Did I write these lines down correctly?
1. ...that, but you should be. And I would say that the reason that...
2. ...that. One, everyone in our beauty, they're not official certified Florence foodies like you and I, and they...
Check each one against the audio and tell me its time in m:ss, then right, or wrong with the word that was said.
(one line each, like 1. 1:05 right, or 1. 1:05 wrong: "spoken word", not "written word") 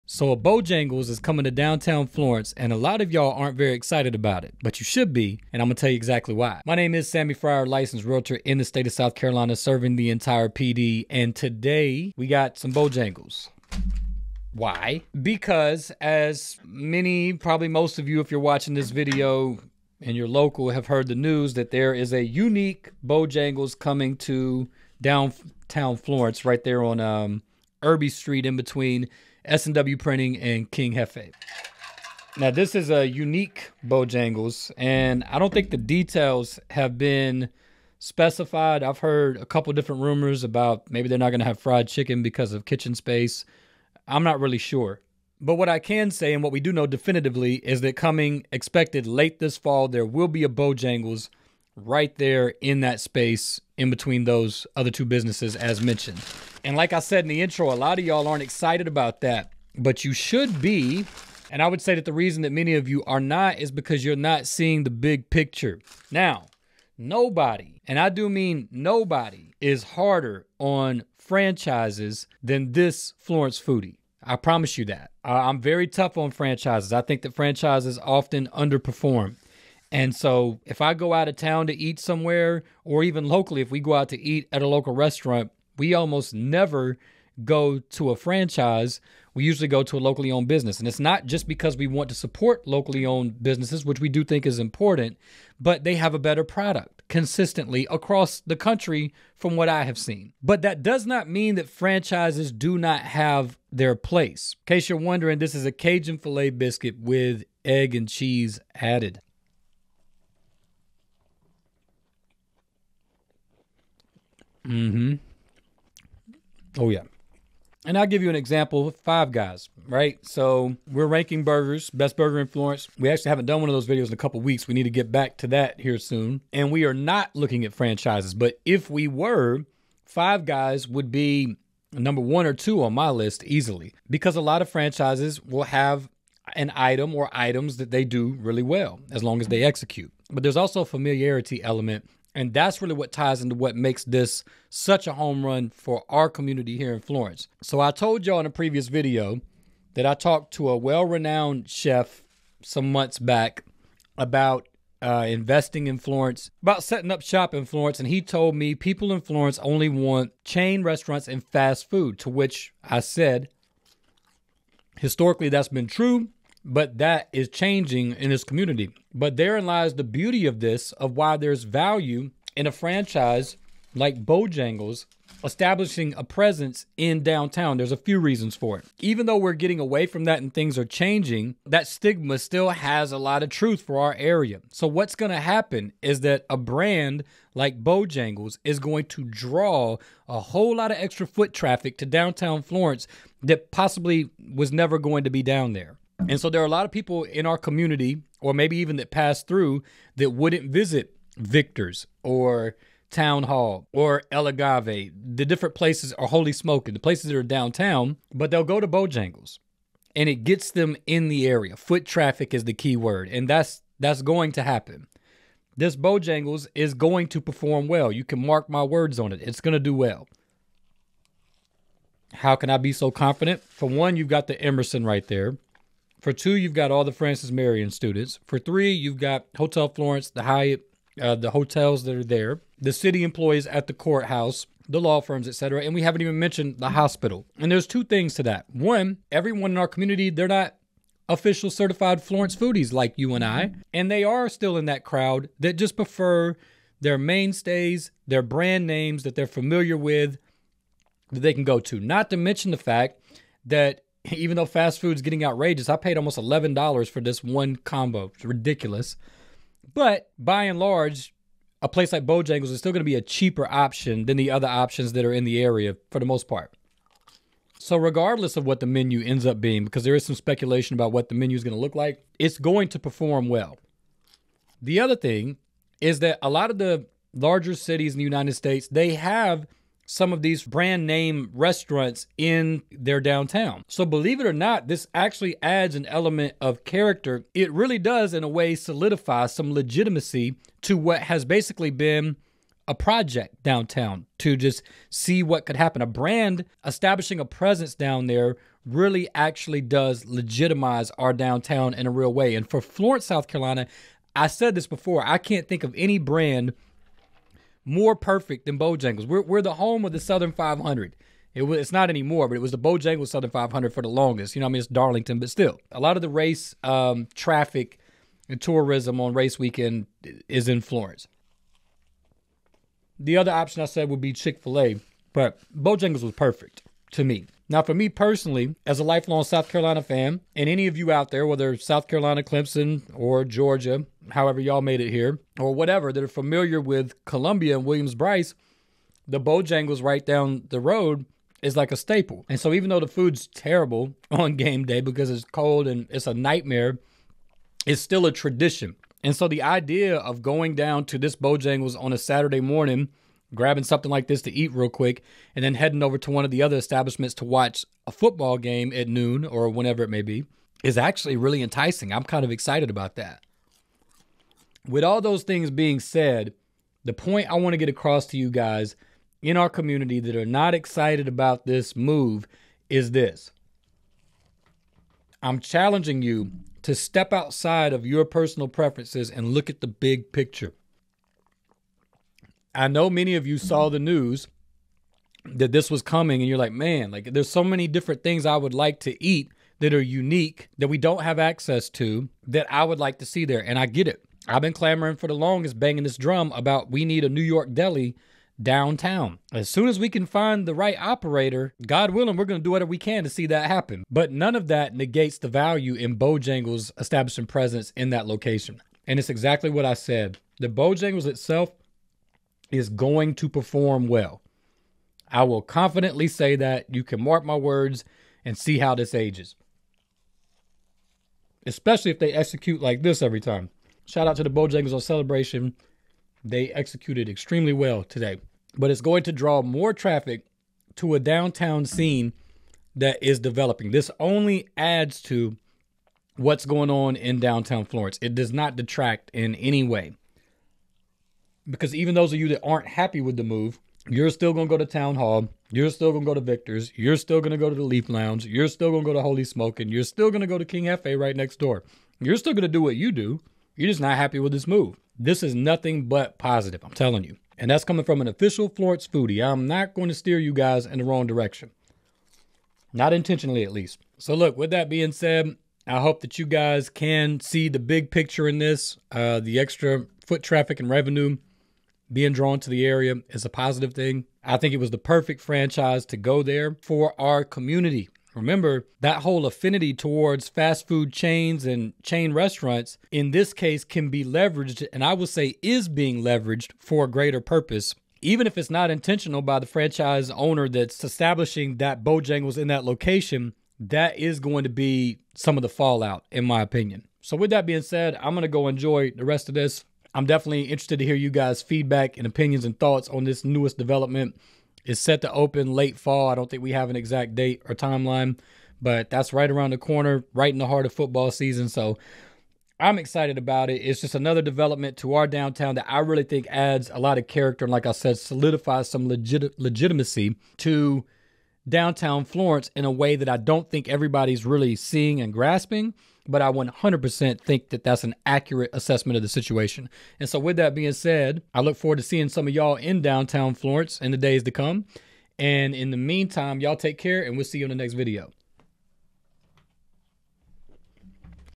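1. 0:59 right
2. 3:58 wrong: "community", not "beauty".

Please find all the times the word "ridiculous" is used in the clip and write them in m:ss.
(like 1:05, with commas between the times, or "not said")
4:18.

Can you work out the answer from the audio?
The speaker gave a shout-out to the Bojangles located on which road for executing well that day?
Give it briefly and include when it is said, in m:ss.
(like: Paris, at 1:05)
Celebration, at 7:05.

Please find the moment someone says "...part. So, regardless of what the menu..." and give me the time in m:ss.
4:26.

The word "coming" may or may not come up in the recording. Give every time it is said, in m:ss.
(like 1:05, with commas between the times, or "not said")
0:01, 0:23, 0:47, 6:26, 7:37.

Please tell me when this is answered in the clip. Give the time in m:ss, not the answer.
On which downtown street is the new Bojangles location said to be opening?
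0:27.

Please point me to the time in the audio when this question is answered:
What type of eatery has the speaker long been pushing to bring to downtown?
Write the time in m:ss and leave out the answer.
6:37.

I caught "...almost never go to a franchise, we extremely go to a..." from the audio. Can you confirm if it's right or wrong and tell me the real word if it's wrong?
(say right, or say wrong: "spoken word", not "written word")
wrong: "usually", not "extremely".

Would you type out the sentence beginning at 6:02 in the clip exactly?
I'm kind of excited about that.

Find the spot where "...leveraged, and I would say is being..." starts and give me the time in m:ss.
8:04.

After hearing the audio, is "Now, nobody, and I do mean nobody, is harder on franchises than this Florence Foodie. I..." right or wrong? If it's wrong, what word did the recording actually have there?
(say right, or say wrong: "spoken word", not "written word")
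right.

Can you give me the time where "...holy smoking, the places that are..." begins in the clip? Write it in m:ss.
3:26.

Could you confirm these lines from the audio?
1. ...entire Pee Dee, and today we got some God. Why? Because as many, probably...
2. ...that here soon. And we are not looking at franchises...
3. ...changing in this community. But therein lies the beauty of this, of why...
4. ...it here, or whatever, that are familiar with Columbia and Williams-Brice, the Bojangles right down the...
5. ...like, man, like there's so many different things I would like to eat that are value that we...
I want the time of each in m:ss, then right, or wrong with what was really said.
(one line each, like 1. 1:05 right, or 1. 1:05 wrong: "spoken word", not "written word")
1. 0:10 wrong: "Bojangles", not "God"
2. 2:05 right
3. 2:47 right
4. 5:34 right
5. 6:26 wrong: "unique", not "value".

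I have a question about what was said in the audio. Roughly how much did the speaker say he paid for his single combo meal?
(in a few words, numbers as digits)
$11.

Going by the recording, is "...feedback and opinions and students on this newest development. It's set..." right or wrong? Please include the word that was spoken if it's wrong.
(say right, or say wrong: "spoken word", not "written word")
wrong: "thoughts", not "students".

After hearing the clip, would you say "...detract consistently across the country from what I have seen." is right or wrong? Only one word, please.
wrong.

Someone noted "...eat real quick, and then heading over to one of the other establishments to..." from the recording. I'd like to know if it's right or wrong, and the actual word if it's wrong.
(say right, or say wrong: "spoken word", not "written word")
right.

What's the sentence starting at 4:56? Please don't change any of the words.
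A brand establishing a presence down there really actually does legitimize our downtown in a real way.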